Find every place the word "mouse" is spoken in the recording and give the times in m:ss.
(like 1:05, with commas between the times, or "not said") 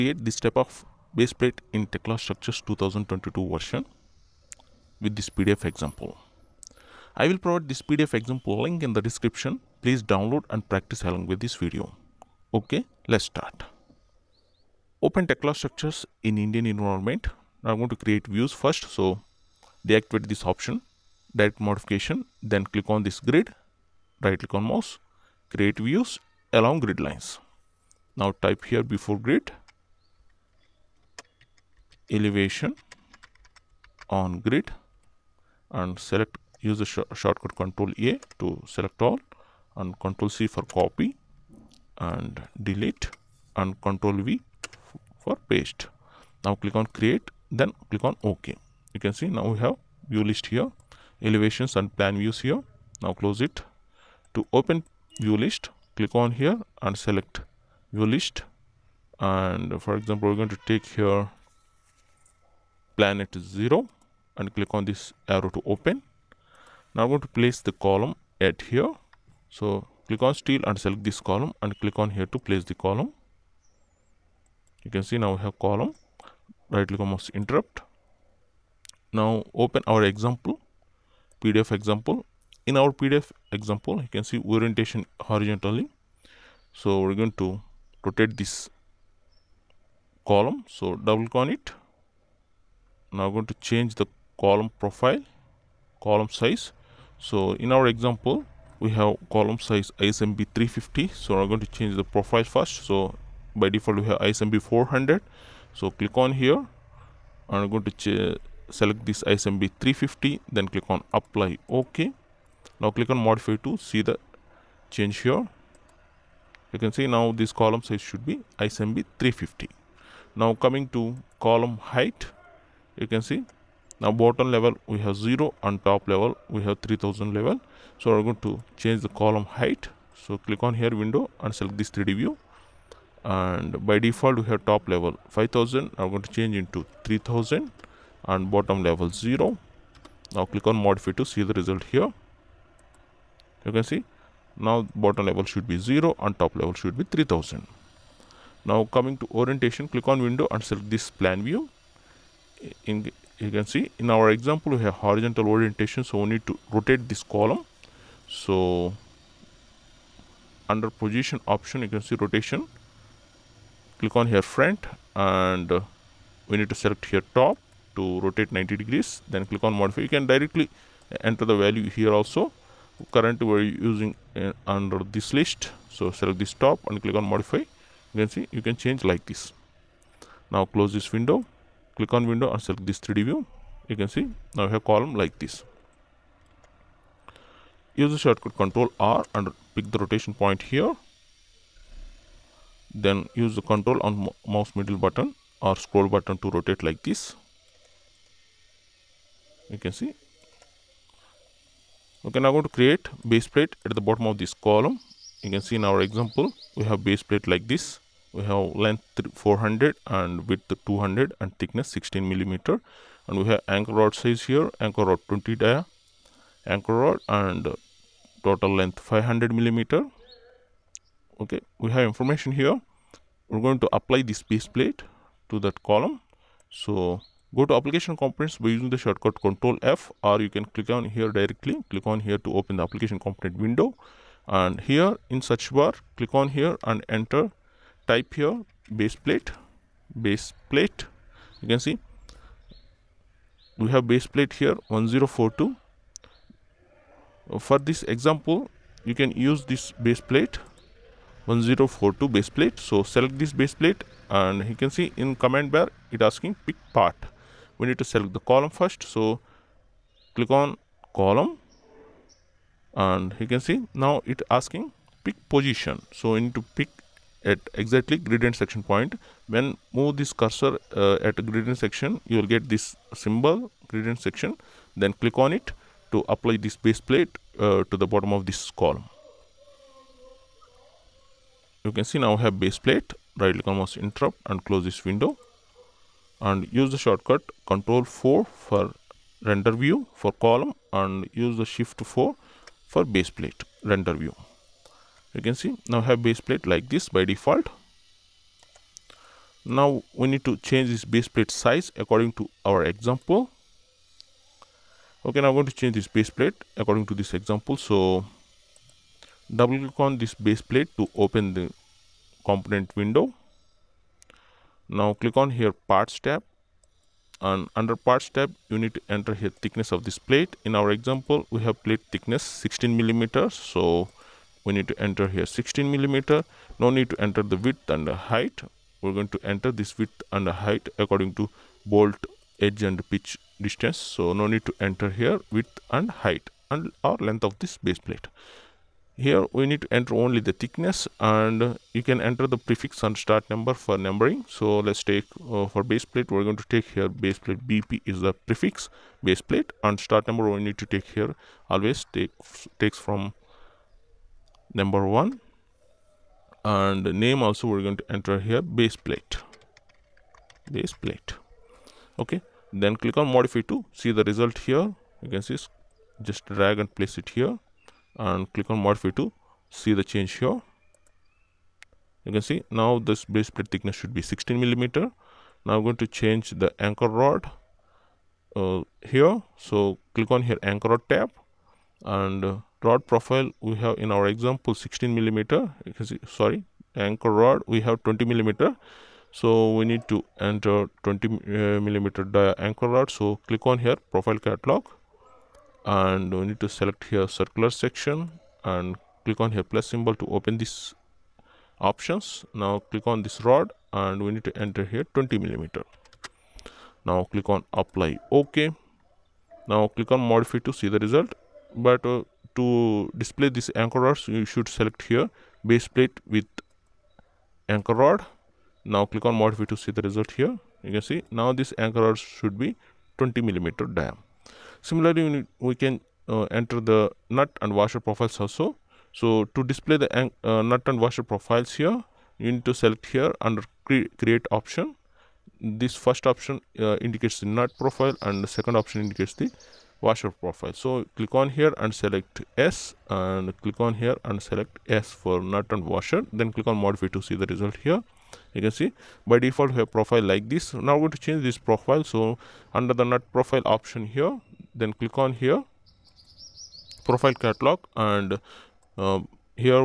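0:24, 1:17, 3:14, 4:43.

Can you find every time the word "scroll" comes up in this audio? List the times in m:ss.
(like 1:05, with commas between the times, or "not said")
3:15.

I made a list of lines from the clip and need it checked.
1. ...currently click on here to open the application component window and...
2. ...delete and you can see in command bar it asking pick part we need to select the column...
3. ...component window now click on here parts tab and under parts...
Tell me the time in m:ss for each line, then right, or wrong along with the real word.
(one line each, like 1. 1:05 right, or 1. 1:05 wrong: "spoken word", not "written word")
1. 3:51 wrong: "directly", not "currently"
2. 4:13 wrong: "plate", not "delete"
3. 5:12 right.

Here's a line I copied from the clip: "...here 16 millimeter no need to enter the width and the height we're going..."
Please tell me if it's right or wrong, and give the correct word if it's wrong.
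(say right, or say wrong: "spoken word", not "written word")
right.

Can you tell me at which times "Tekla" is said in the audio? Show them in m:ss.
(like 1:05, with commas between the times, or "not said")
0:01, 0:15.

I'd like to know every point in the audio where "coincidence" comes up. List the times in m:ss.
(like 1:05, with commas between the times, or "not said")
not said.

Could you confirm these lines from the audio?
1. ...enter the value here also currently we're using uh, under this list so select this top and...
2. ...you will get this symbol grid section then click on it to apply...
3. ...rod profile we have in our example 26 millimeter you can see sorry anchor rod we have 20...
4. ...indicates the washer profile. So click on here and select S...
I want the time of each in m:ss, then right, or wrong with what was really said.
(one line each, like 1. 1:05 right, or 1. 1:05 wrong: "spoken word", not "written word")
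1. 2:51 right
2. 4:32 wrong: "intersection", not "section"
3. 6:22 wrong: "16", not "26"
4. 7:18 right.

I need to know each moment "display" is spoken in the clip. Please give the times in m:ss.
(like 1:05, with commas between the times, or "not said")
6:53, 7:09.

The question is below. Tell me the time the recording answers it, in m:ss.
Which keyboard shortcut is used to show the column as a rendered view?
4:47.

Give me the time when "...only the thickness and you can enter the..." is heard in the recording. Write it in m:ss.
5:40.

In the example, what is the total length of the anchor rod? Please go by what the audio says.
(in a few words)
500 millimeter.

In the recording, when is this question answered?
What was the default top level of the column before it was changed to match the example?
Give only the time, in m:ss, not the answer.
2:14.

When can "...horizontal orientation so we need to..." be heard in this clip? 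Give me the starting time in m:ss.
2:35.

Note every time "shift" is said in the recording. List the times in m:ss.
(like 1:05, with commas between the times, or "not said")
4:51.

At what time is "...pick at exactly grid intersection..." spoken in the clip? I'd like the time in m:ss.
4:26.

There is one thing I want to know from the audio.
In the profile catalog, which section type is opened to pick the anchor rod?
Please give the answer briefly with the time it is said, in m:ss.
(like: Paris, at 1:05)
circular section, at 6:37.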